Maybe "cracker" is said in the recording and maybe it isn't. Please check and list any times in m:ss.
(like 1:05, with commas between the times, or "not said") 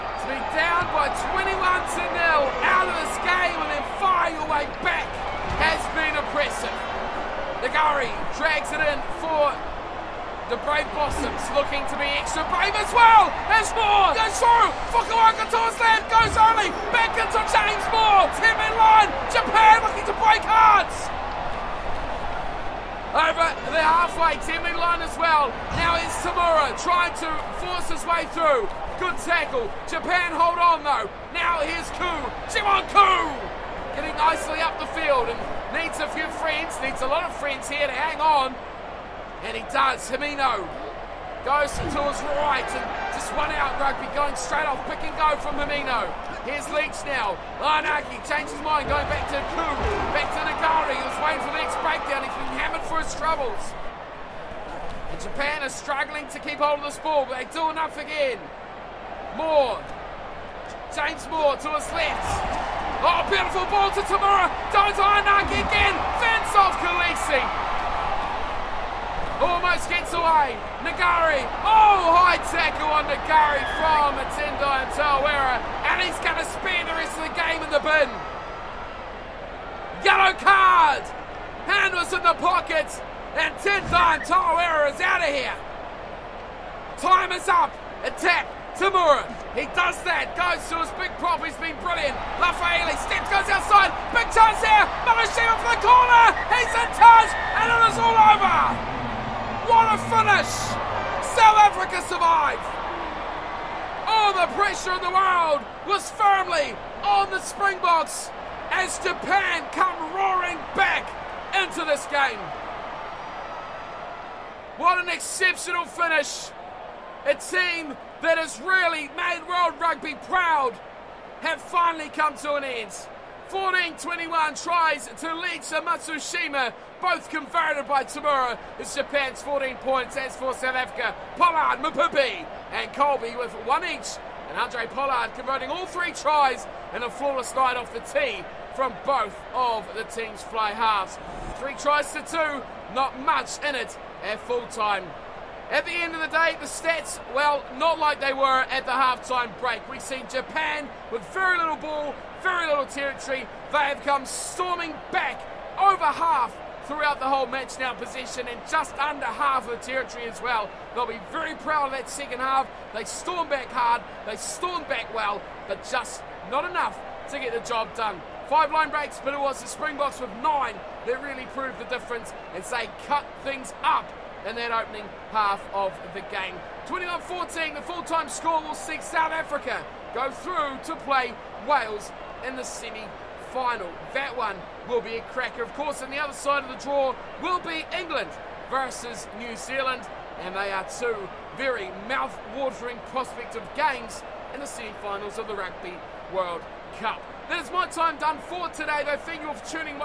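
3:05.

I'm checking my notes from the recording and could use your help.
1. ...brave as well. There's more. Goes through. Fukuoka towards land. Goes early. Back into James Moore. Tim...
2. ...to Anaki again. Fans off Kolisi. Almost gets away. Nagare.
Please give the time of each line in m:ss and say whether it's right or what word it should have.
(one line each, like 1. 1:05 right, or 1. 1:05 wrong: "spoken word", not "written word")
1. 0:12 right
2. 1:04 right.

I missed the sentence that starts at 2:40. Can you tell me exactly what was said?
They'll be very proud of that second half.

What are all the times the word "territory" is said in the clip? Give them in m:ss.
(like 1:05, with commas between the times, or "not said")
2:32, 2:39.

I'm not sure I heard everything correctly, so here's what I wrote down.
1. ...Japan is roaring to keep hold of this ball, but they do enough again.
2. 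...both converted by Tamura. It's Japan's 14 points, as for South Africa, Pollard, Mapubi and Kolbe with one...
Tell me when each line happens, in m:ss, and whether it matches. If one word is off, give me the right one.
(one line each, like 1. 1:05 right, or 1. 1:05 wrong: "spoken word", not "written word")
1. 0:55 wrong: "struggling", not "roaring"
2. 2:07 right.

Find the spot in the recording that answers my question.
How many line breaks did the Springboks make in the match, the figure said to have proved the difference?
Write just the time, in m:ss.
2:50.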